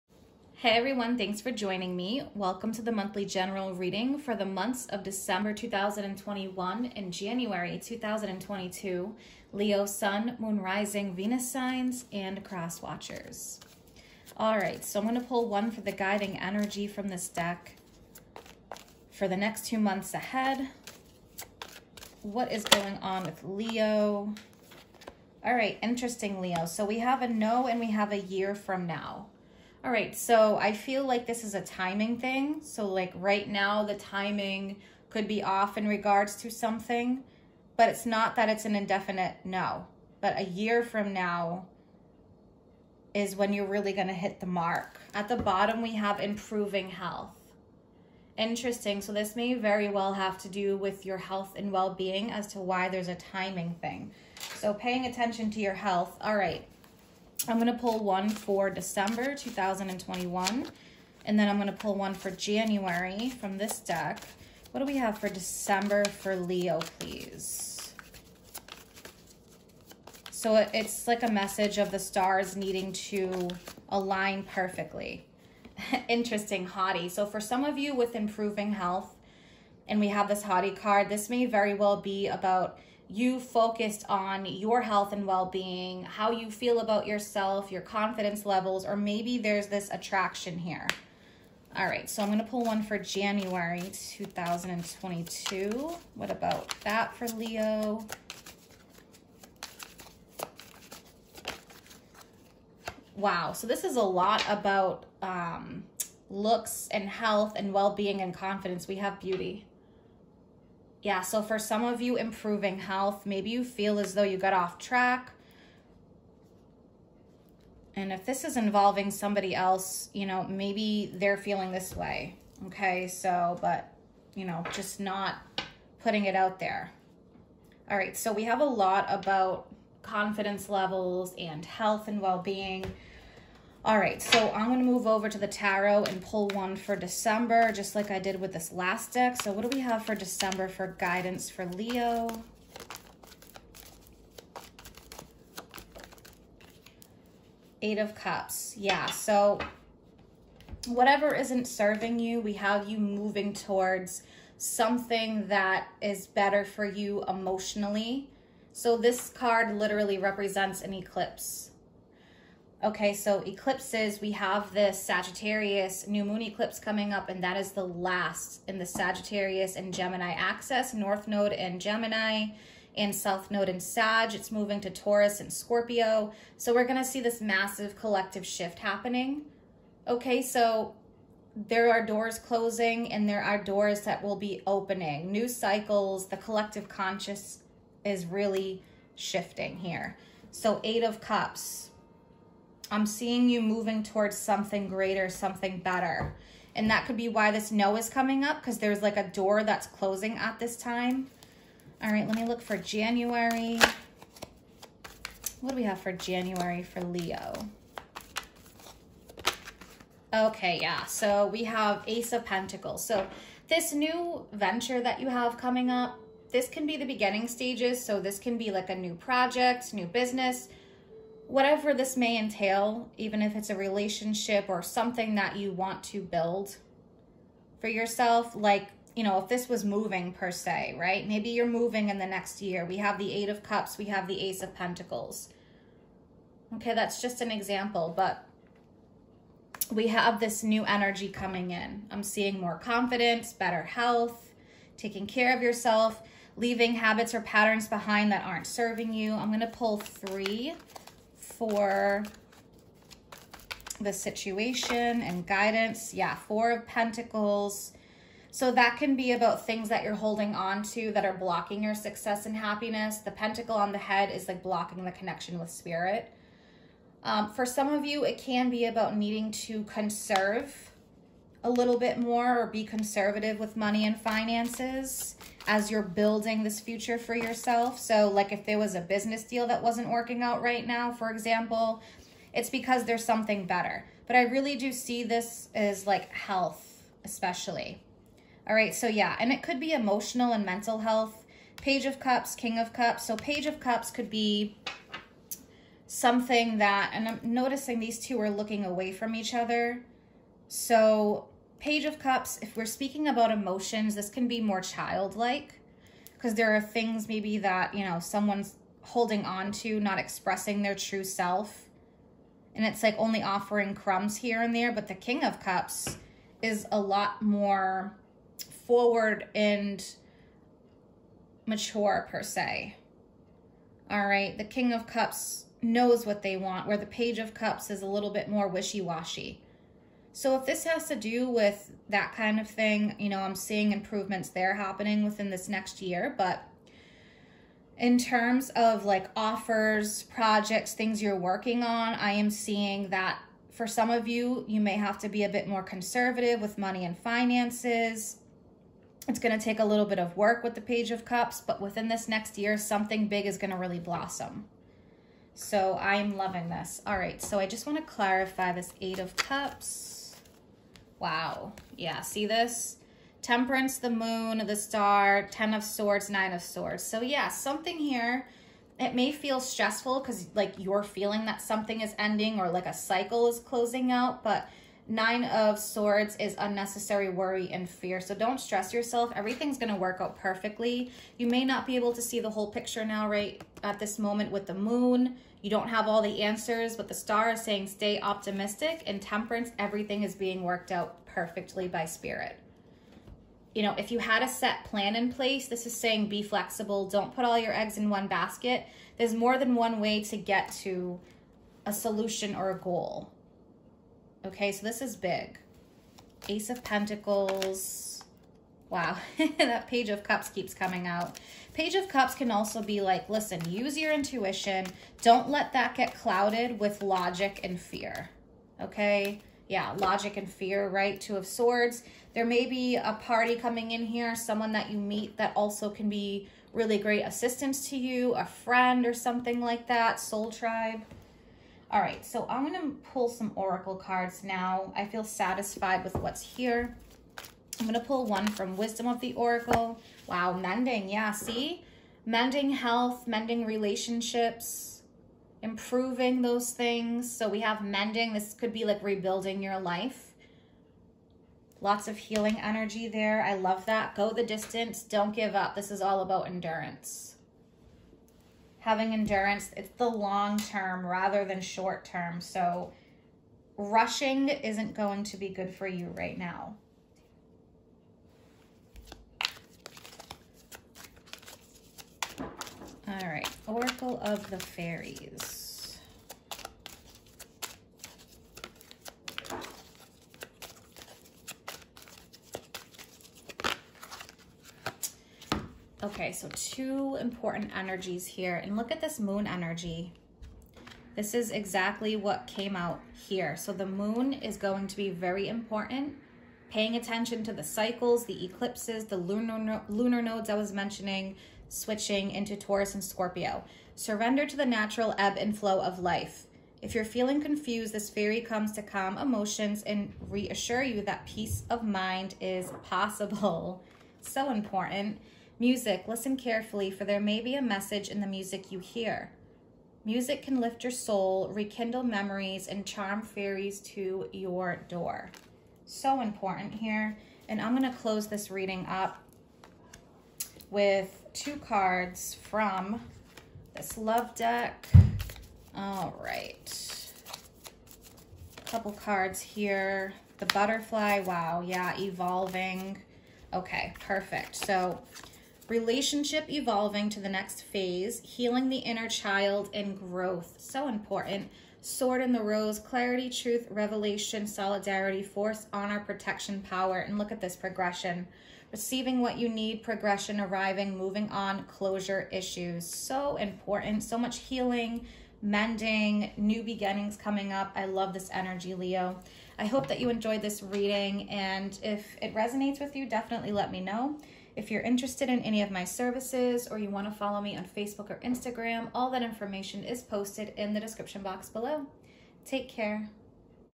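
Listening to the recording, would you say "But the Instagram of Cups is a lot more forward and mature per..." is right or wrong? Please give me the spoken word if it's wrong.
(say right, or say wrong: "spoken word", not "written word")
wrong: "King", not "Instagram".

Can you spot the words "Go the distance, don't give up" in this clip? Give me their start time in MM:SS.
07:34.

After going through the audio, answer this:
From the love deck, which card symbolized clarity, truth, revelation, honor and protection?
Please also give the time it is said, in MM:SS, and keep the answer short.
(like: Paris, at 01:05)
Sword in the rose, at 09:11.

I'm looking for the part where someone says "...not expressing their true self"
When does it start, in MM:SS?
05:09.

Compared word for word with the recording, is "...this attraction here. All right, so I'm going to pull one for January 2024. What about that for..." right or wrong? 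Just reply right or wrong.
wrong.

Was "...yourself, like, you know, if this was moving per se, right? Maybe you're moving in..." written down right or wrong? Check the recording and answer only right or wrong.
right.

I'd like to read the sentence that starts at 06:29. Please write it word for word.
Everything is being worked out perfectly by spirit.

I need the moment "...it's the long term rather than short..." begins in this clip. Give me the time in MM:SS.
07:39.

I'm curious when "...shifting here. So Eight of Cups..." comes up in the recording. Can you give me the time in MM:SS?
03:09.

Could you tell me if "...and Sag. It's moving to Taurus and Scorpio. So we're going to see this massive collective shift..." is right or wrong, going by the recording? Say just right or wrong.
right.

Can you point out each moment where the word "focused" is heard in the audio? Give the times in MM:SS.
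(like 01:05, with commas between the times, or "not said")
01:23.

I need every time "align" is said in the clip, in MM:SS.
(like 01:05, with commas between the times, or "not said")
01:13.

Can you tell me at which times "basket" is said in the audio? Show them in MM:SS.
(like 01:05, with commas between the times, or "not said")
06:38.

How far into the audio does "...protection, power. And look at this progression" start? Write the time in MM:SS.
09:16.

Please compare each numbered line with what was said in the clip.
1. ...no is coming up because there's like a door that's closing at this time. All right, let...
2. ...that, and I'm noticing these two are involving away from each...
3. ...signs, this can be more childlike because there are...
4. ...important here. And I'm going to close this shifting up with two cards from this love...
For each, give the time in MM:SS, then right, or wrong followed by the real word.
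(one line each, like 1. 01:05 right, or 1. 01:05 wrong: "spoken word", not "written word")
1. 03:17 right
2. 04:56 wrong: "looking", not "involving"
3. 05:03 wrong: "emotions", not "signs"
4. 08:46 wrong: "reading", not "shifting".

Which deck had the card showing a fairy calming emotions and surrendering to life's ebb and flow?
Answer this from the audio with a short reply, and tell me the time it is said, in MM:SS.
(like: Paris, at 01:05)
Oracle of the Fairies, at 07:53.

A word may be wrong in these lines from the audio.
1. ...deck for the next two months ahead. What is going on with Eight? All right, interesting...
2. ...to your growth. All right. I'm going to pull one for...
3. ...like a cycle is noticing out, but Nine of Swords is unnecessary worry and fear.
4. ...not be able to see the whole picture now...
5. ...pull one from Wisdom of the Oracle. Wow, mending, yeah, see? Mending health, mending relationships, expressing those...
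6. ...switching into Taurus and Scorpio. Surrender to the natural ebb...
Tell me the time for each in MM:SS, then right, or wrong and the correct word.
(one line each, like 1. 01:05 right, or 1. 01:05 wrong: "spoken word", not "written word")
1. 00:17 wrong: "Leo", not "Eight"
2. 00:55 wrong: "health", not "growth"
3. 06:12 wrong: "closing", not "noticing"
4. 06:21 right
5. 07:17 wrong: "improving", not "expressing"
6. 08:21 right.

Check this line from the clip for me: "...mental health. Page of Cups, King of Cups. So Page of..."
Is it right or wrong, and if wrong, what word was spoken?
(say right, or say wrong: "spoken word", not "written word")
right.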